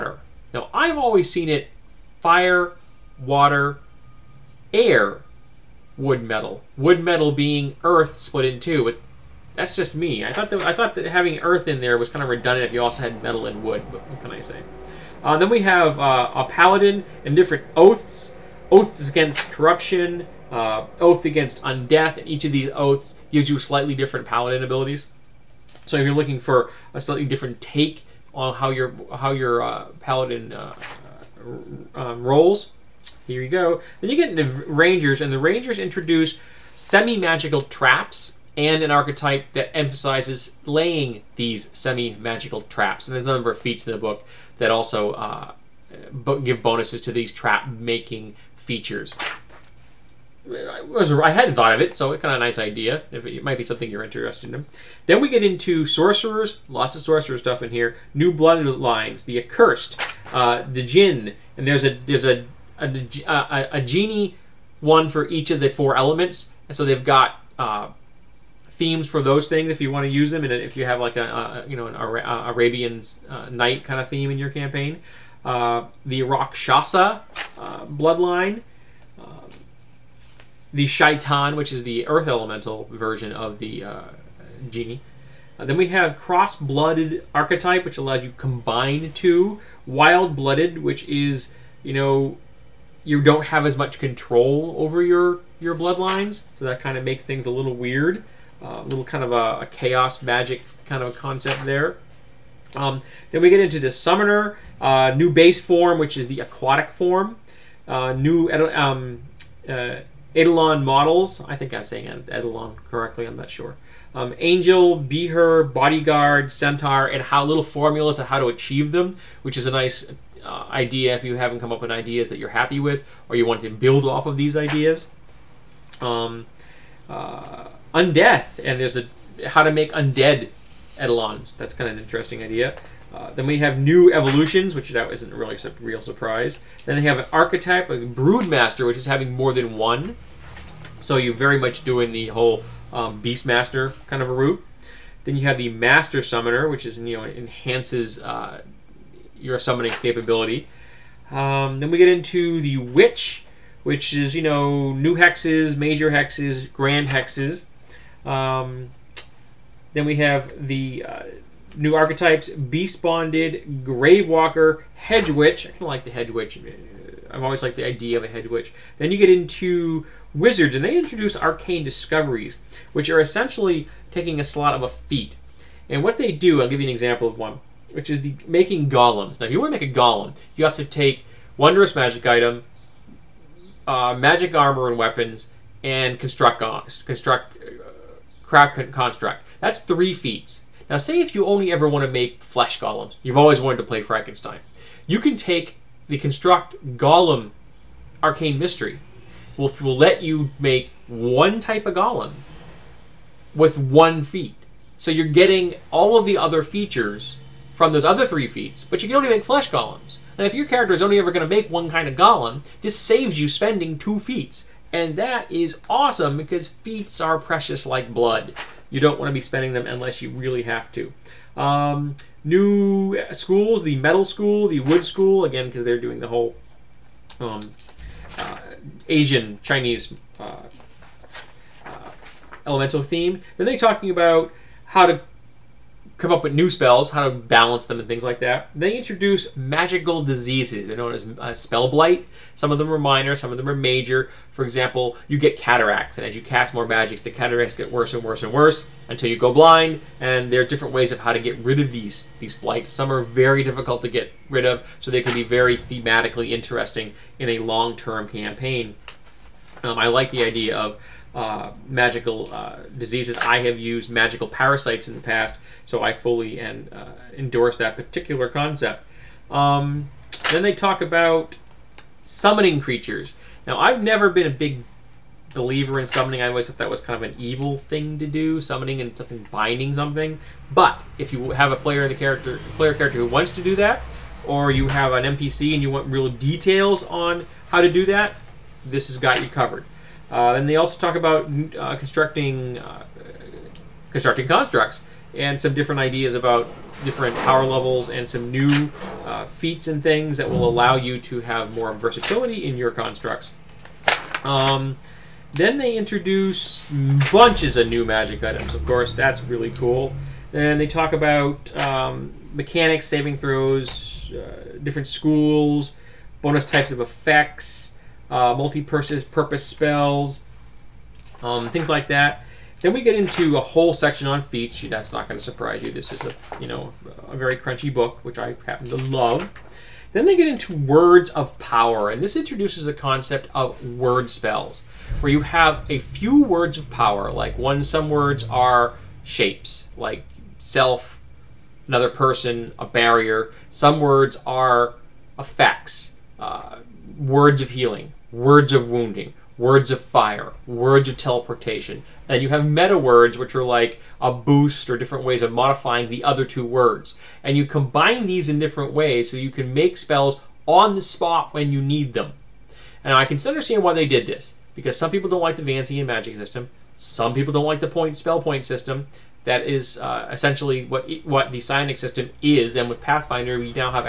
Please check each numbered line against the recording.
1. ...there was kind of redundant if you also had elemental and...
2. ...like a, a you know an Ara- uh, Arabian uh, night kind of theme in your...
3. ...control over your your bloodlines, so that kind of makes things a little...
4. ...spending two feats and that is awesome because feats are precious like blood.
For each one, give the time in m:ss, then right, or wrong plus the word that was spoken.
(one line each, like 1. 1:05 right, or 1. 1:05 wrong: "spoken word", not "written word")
1. 0:11 wrong: "metal", not "elemental"
2. 1:10 right
3. 1:33 right
4. 3:33 right.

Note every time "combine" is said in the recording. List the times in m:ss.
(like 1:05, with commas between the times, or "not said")
1:28, 5:57.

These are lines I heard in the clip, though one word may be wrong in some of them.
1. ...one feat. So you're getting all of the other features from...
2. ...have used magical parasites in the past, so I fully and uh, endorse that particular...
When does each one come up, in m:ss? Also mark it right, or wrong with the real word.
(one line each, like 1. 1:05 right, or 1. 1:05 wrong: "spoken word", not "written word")
1. 3:23 right
2. 4:23 right.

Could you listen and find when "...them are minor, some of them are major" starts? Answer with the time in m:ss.
4:02.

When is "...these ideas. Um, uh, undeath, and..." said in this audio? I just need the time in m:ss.
2:04.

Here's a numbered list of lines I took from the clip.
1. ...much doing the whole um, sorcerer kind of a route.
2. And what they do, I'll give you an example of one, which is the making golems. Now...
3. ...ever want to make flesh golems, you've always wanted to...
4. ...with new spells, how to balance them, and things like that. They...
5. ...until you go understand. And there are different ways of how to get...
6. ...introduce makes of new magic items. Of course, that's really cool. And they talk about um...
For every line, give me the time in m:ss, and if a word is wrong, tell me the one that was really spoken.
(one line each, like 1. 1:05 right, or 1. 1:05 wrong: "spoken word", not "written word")
1. 2:21 wrong: "beastmaster", not "sorcerer"
2. 2:55 right
3. 3:11 right
4. 3:56 right
5. 4:09 wrong: "blind", not "understand"
6. 5:05 wrong: "bunches", not "makes".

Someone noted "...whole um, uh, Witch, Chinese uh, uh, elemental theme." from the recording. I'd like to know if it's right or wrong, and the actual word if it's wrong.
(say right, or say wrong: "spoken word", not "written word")
wrong: "Asian", not "Witch".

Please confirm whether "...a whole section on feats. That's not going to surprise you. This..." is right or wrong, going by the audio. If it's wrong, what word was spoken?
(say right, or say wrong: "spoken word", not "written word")
right.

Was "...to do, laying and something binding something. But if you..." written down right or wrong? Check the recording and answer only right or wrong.
wrong.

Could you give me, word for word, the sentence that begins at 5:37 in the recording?
Like one, some words are shapes, like self, another person, a barrier.